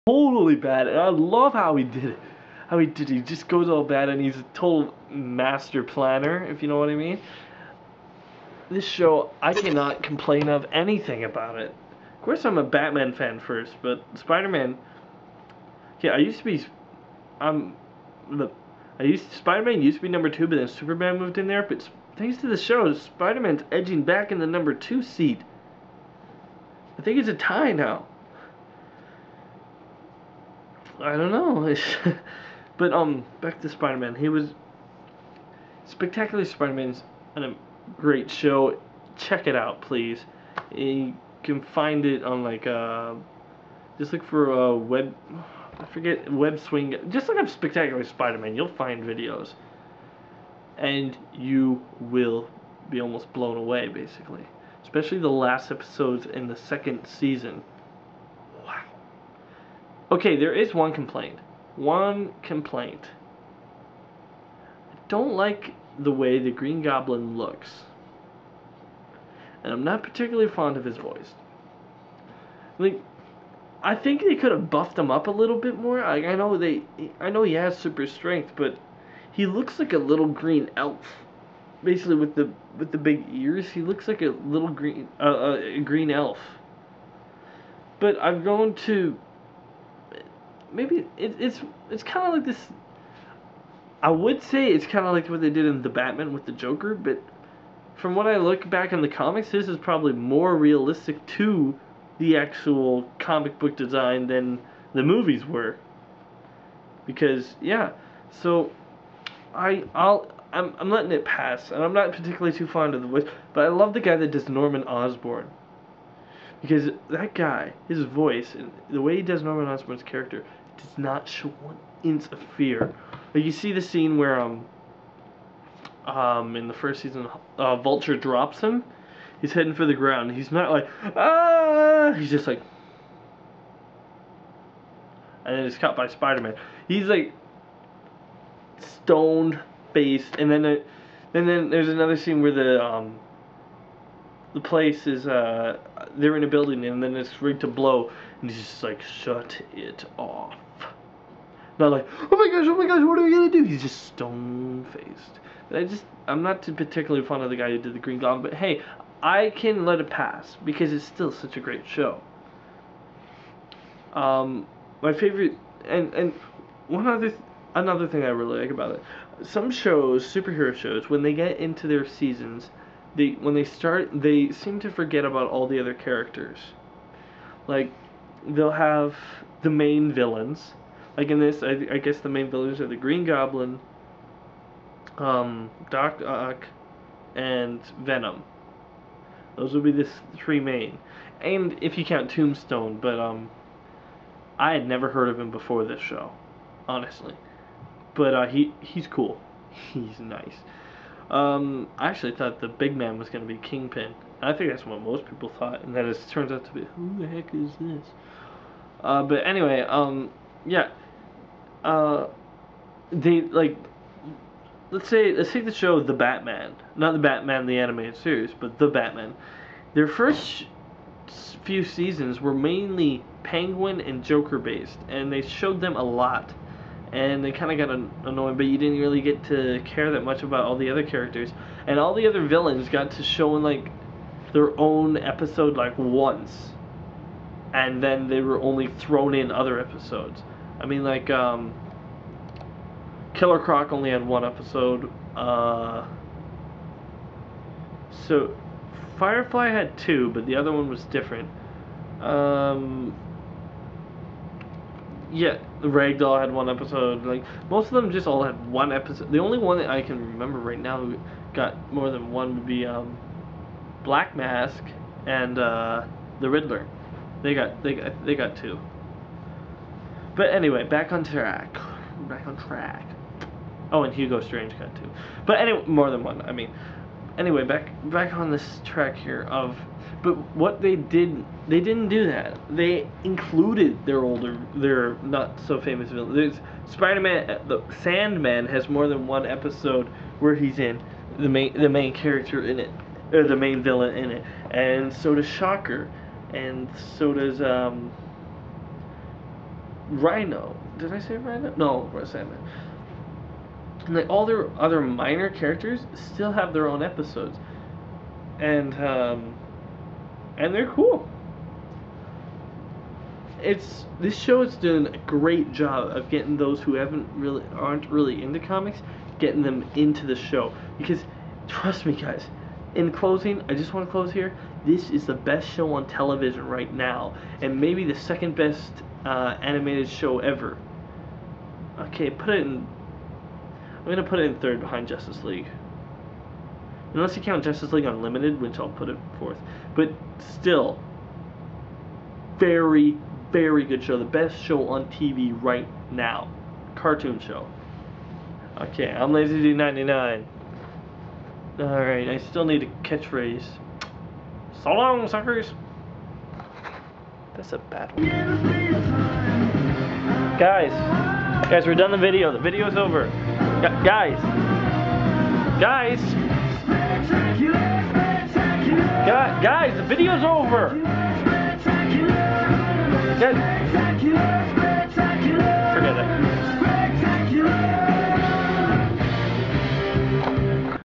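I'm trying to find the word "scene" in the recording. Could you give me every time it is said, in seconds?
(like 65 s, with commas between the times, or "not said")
123 s, 142 s.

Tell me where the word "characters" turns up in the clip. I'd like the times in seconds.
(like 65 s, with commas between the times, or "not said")
120 s, 175 s, 231 s, 292 s, 305 s.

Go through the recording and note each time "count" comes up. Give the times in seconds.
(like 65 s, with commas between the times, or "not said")
192 s, 337 s.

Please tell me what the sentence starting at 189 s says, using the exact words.
Those would be the three main.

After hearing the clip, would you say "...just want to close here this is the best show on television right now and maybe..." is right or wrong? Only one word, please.
right.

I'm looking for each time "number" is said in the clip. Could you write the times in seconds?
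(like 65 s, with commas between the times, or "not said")
20 s, 24 s.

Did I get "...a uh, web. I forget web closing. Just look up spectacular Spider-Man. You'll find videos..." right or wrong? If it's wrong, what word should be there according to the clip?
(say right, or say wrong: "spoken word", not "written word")
wrong: "swing", not "closing".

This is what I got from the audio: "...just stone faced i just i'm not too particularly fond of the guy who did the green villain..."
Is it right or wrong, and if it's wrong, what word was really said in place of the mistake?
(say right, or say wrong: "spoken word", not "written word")
wrong: "goblin", not "villain".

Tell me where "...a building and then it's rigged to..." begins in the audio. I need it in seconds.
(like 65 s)
146 s.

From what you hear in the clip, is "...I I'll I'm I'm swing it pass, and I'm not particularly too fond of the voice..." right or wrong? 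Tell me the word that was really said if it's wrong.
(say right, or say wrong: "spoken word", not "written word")
wrong: "letting", not "swing".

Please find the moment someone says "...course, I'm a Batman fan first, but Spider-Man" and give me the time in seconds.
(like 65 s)
12 s.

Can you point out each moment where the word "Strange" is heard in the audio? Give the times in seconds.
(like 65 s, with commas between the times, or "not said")
274 s.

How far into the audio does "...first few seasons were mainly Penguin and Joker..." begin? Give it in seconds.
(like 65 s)
220 s.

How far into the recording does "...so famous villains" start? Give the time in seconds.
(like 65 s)
285 s.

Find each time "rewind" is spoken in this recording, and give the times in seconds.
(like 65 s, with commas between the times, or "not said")
not said.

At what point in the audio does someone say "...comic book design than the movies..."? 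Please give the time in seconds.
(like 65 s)
103 s.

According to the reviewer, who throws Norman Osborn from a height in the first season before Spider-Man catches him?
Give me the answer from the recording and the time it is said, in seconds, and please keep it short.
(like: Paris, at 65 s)
Vulture, at 127 s.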